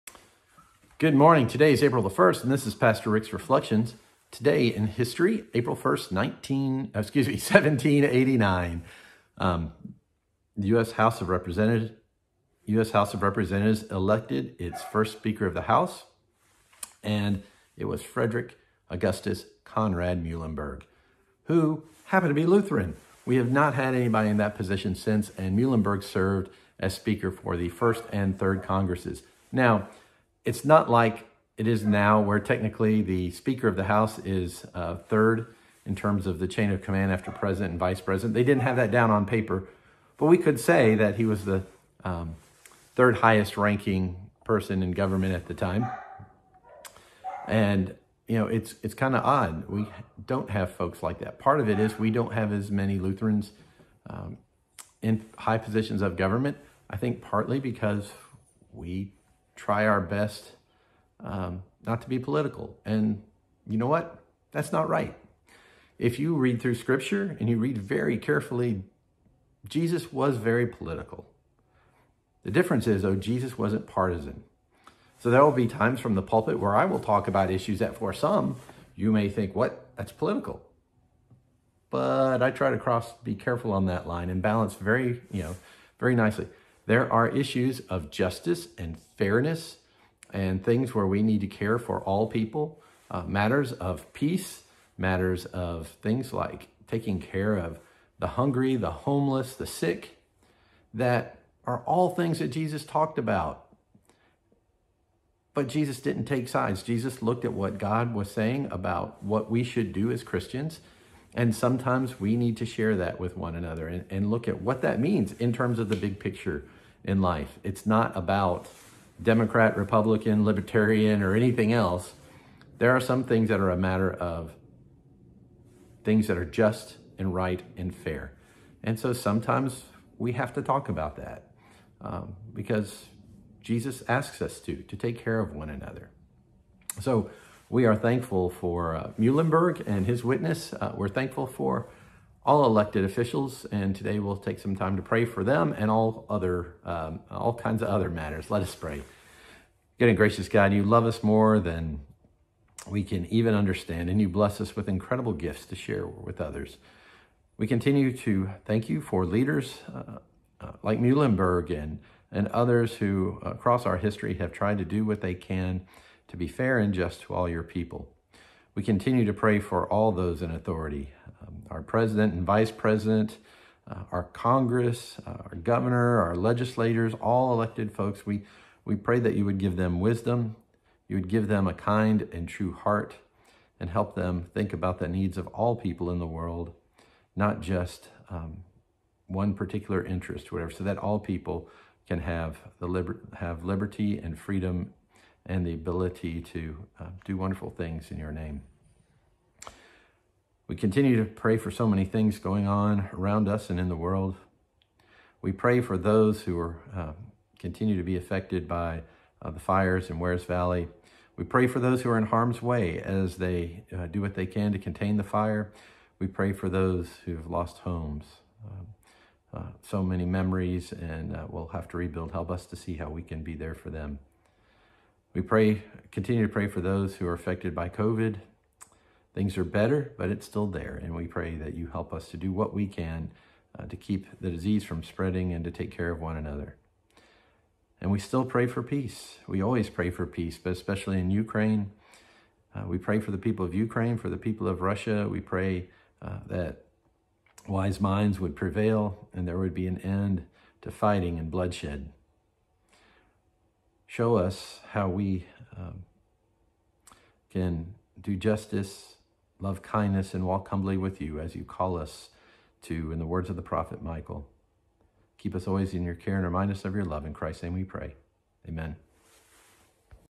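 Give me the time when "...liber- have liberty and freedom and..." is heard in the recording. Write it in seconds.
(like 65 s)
192 s.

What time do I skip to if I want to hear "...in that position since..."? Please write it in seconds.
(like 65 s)
24 s.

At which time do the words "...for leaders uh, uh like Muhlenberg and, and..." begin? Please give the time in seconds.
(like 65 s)
158 s.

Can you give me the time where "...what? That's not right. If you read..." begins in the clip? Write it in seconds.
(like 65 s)
63 s.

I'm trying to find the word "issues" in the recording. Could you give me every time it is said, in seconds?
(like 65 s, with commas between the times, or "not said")
77 s, 87 s.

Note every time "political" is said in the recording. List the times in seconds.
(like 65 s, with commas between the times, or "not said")
62 s, 70 s, 80 s.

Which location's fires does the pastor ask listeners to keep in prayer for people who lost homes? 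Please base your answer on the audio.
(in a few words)
Wears Valley.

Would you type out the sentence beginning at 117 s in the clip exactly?
It's not about Democrat, Republican, Libertarian, or anything else.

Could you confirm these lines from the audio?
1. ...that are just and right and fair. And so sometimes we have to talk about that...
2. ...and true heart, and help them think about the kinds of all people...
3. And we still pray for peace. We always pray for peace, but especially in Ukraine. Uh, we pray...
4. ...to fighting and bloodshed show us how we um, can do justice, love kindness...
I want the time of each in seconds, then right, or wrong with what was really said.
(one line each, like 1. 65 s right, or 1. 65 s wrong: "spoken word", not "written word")
1. 126 s right
2. 182 s wrong: "needs", not "kinds"
3. 238 s right
4. 250 s right.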